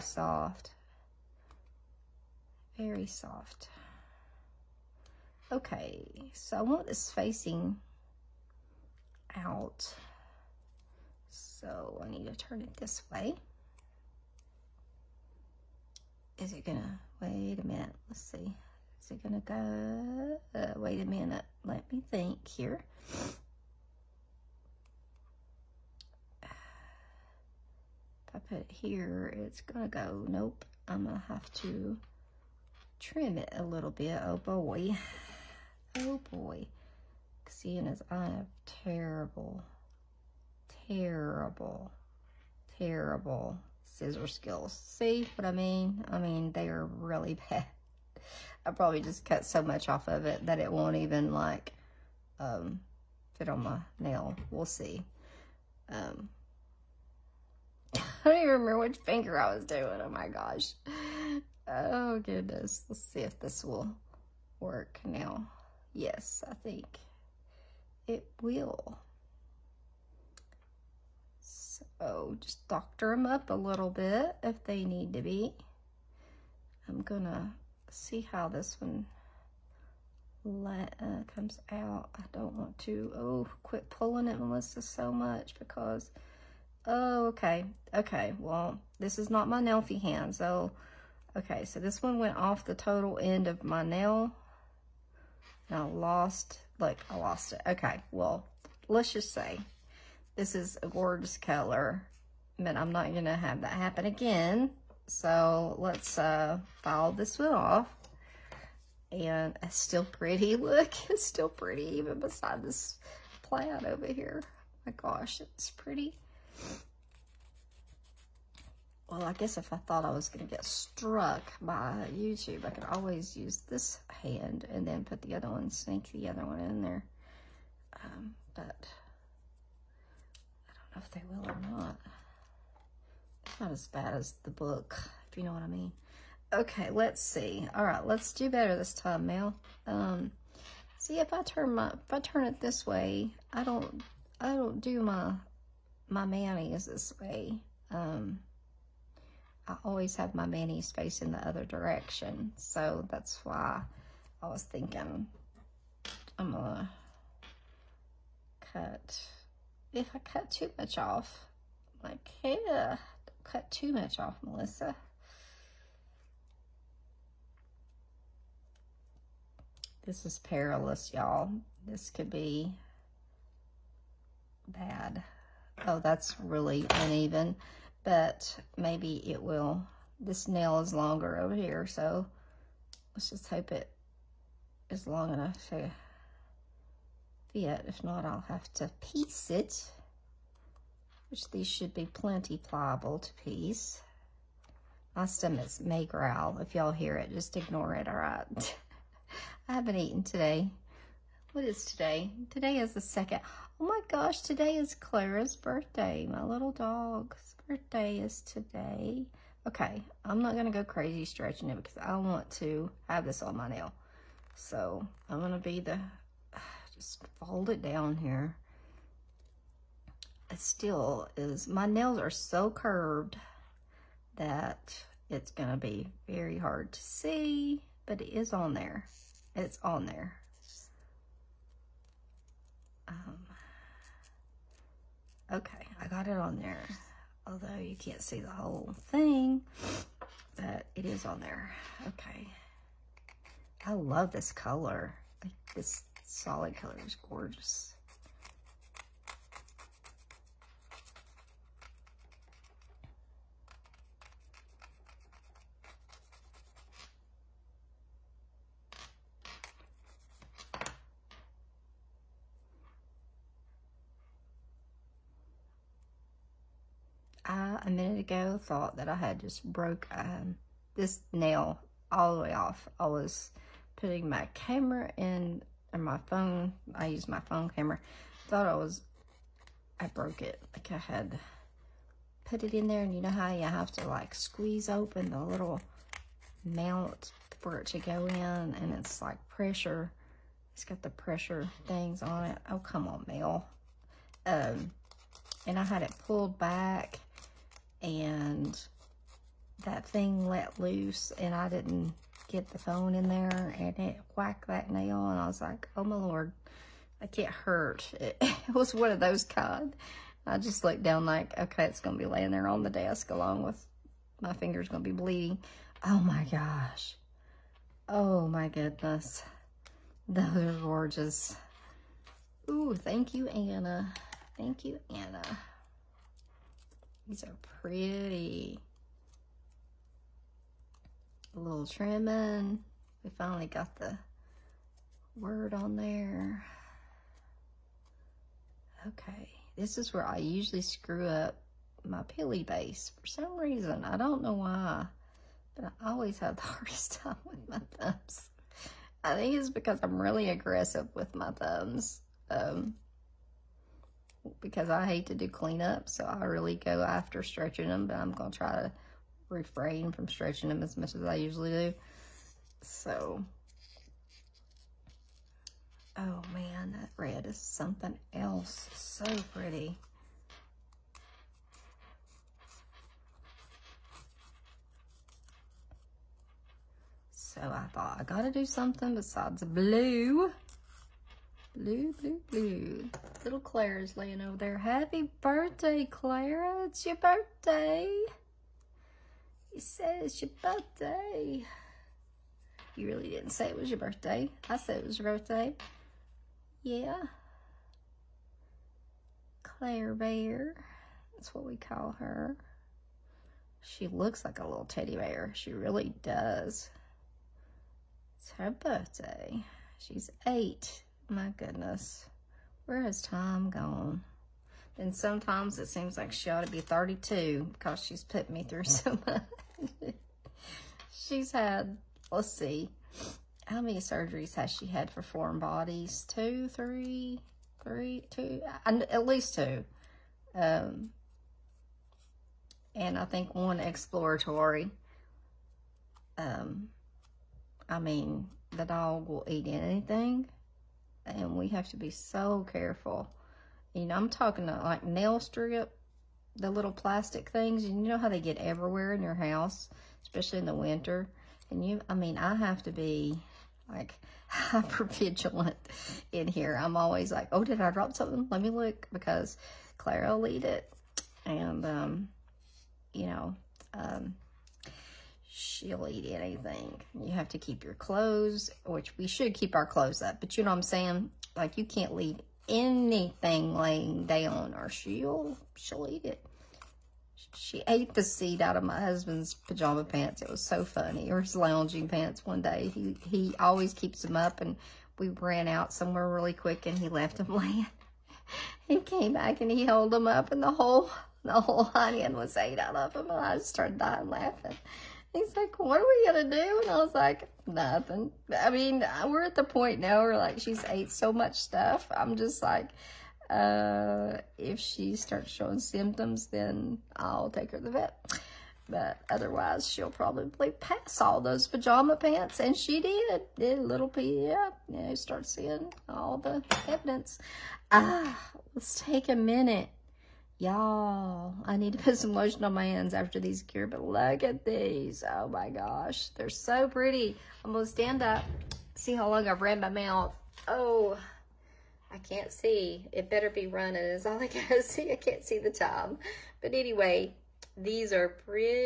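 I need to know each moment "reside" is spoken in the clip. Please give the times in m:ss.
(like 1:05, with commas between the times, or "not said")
not said.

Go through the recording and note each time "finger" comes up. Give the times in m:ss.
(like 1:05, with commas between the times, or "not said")
0:58, 5:14.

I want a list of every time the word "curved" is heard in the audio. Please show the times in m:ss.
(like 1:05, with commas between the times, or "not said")
3:42.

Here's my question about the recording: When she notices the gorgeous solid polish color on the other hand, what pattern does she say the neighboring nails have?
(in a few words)
plaid.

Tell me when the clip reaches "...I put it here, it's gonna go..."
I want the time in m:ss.
0:28.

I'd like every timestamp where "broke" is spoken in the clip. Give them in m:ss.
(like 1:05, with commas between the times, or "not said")
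4:29, 4:40.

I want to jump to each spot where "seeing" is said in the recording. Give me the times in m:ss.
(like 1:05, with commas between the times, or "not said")
0:37, 8:35.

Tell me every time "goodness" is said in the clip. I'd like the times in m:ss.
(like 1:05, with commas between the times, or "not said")
1:02, 5:18, 6:51.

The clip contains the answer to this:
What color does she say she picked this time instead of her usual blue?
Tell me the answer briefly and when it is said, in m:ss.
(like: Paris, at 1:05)
red, at 6:07.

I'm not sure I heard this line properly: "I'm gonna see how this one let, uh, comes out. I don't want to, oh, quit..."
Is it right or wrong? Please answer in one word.
right.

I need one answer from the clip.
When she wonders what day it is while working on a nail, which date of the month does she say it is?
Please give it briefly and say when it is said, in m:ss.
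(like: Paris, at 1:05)
the 2nd, at 3:22.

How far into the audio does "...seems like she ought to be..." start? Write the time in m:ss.
6:55.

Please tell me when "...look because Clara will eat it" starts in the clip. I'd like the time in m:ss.
7:38.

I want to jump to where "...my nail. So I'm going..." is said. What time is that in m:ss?
3:33.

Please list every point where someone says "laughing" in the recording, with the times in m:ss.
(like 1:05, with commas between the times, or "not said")
8:14.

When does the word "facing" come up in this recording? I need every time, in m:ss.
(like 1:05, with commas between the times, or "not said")
0:07, 2:30.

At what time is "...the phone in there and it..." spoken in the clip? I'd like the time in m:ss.
5:02.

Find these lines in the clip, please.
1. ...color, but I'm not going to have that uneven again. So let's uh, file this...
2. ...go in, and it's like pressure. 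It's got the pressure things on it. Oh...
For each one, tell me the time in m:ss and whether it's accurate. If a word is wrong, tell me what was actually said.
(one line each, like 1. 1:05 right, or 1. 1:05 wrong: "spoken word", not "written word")
1. 1:41 wrong: "happen", not "uneven"
2. 4:47 right.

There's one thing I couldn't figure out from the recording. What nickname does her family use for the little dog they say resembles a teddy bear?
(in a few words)
Claire Bear.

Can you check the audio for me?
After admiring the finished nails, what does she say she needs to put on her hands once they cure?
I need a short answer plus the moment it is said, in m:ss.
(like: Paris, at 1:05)
lotion, at 8:42.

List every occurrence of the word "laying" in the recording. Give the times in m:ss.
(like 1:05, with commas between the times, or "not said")
5:12, 6:24, 7:53, 8:07.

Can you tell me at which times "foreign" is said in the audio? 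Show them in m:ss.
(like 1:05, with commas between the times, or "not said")
7:05.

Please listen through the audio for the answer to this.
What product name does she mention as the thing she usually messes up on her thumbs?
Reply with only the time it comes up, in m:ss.
5:42.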